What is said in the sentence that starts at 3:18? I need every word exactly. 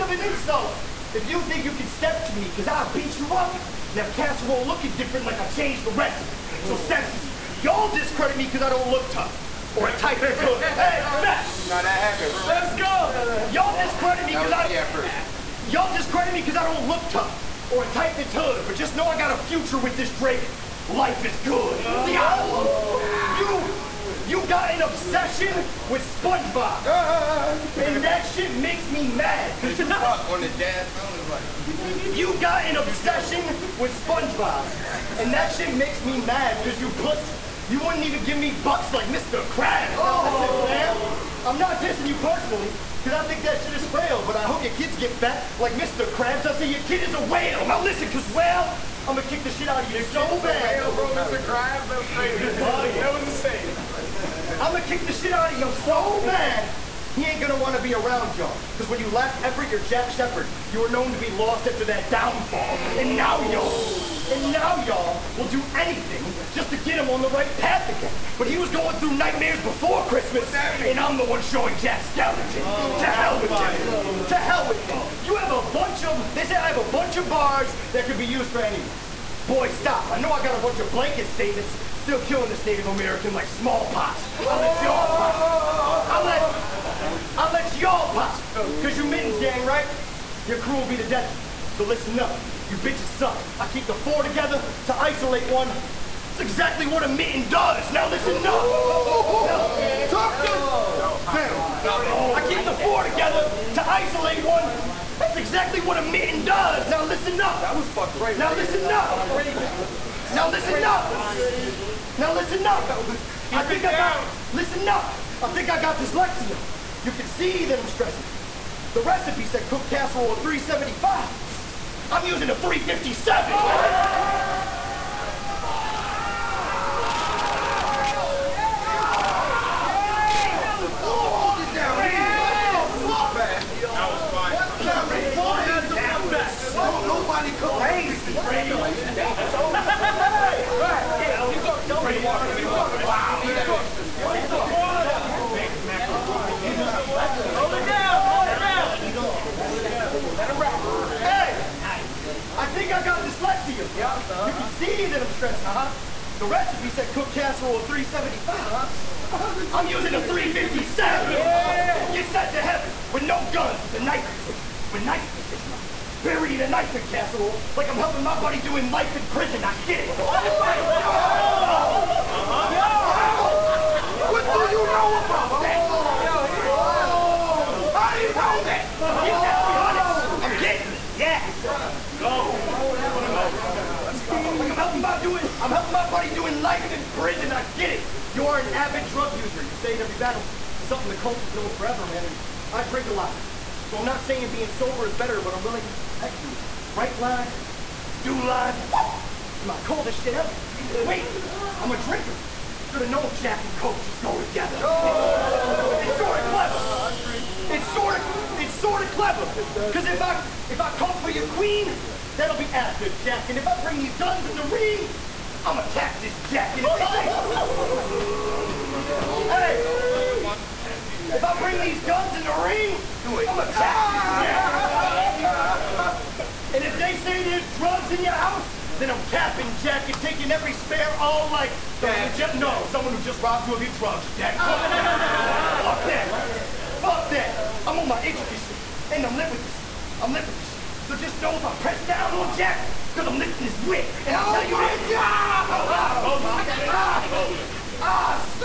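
Like, this is my coldest shit ever.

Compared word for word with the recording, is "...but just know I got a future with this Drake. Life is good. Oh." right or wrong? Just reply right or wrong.
right.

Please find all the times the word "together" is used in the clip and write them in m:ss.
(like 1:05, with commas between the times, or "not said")
1:34, 1:43, 3:24.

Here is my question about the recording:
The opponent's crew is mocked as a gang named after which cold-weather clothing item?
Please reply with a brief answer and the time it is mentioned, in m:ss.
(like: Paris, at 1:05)
mittens, at 1:29.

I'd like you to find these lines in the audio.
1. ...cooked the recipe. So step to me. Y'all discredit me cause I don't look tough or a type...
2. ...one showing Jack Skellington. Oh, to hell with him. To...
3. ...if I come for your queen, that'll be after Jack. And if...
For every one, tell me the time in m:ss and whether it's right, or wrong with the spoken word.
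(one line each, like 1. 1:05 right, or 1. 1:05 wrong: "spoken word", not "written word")
1. 0:05 wrong: "changed", not "cooked"
2. 1:11 right
3. 3:30 right.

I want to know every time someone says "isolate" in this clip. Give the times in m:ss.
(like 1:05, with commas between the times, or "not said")
1:34, 1:43.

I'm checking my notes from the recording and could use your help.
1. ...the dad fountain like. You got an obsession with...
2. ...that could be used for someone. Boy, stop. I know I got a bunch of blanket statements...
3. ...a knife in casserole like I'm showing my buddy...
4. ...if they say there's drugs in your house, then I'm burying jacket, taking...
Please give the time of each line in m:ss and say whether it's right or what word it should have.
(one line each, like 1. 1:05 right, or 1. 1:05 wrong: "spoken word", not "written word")
1. 0:30 right
2. 1:17 wrong: "anyone", not "someone"
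3. 2:46 wrong: "helping", not "showing"
4. 3:46 wrong: "capping", not "burying".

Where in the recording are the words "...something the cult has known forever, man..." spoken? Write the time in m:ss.
3:10.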